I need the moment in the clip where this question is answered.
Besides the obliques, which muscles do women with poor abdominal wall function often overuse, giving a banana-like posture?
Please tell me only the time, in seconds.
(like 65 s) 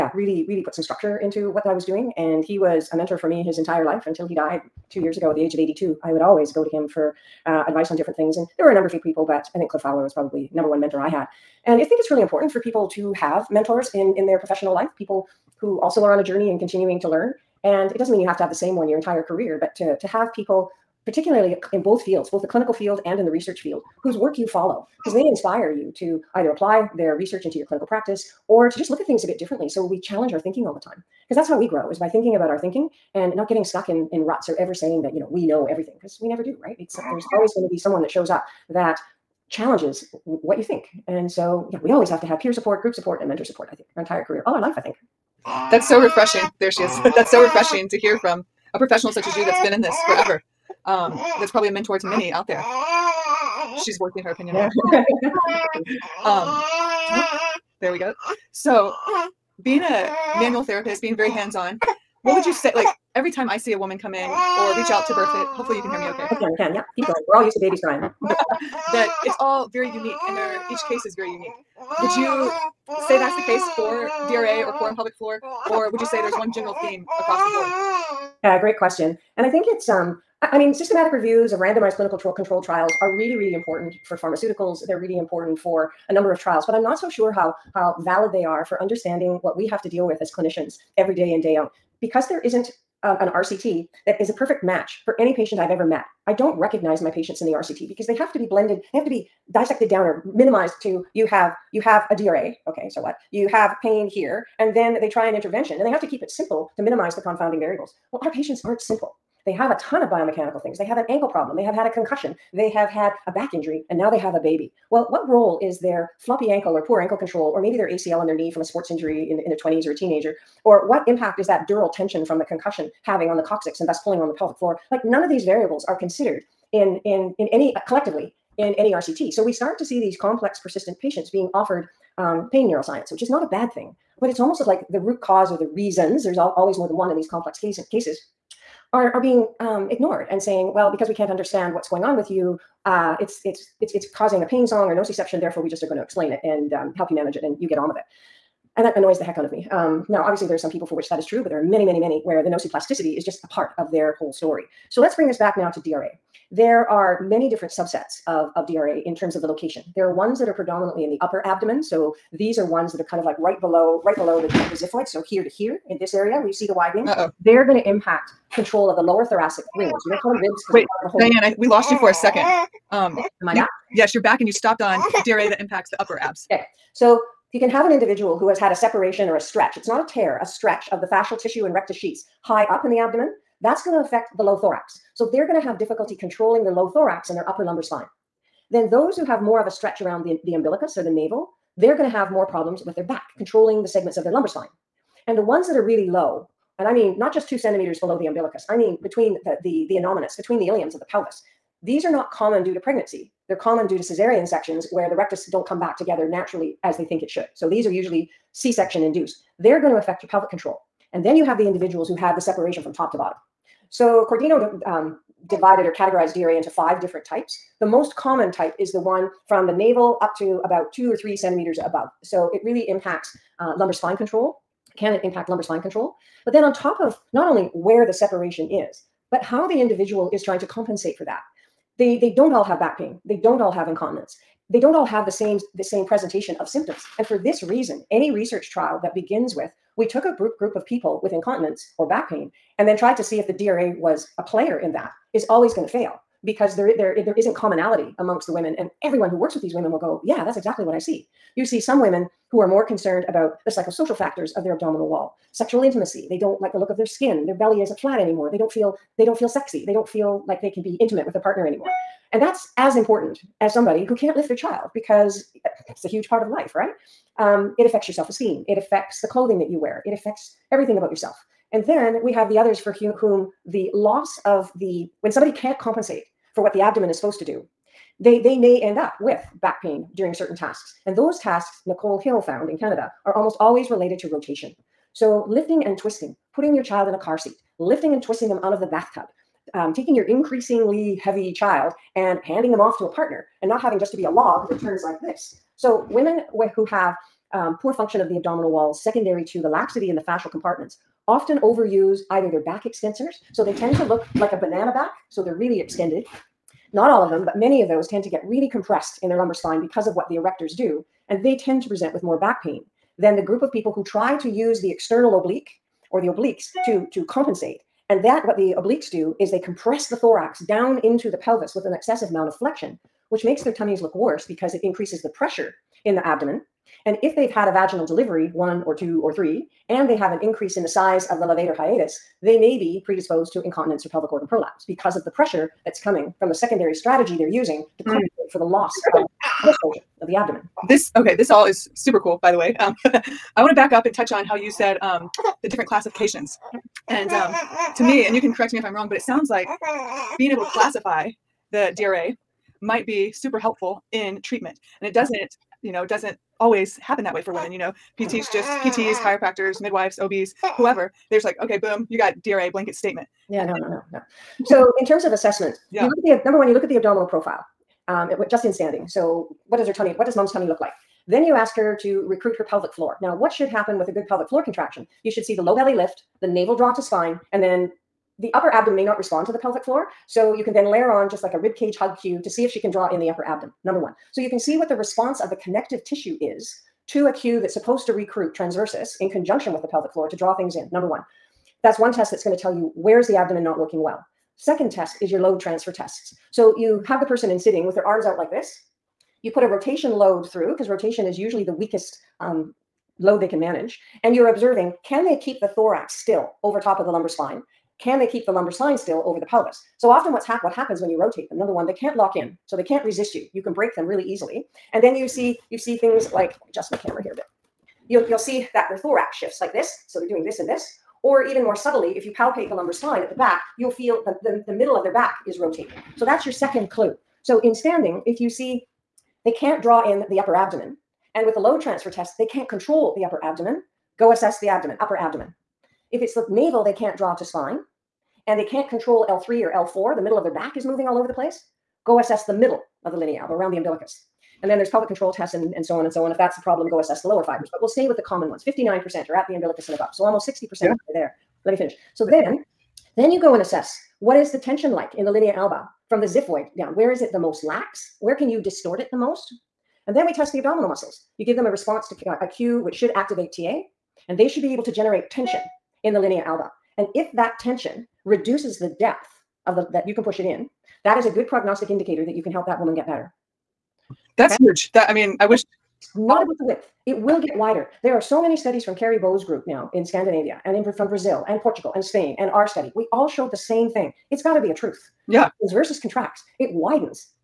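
302 s.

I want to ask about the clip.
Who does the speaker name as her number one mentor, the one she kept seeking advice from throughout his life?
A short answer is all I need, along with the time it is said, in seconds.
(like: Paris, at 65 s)
Cliff Fowler, at 9 s.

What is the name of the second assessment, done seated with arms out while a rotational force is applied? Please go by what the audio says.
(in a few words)
load transfer tests.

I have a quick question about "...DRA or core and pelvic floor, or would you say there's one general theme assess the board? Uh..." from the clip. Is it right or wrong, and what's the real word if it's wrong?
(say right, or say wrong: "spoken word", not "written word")
wrong: "across", not "assess".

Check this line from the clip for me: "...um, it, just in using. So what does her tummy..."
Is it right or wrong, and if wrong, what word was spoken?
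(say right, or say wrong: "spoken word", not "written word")
wrong: "standing", not "using".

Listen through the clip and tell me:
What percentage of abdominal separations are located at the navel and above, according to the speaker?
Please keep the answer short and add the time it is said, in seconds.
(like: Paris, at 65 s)
59%, at 448 s.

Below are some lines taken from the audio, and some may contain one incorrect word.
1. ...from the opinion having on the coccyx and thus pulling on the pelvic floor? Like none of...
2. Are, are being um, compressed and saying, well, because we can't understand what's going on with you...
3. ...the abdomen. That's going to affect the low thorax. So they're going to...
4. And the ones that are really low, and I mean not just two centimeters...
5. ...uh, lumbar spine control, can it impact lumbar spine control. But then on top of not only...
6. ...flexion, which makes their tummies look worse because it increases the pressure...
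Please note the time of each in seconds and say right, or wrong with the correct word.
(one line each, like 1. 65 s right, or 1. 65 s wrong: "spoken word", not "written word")
1. 122 s wrong: "concussion", not "opinion"
2. 138 s wrong: "ignored", not "compressed"
3. 182 s right
4. 195 s right
5. 223 s right
6. 322 s right.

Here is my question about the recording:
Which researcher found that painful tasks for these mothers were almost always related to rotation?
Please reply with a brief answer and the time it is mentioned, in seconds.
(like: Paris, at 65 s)
Nicole Hills, at 281 s.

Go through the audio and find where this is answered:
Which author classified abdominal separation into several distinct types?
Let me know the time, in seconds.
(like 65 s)
214 s.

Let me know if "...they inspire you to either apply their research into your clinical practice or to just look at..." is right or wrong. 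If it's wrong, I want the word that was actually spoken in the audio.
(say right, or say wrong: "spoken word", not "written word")
right.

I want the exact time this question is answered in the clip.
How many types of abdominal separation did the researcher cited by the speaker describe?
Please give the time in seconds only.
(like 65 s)
216 s.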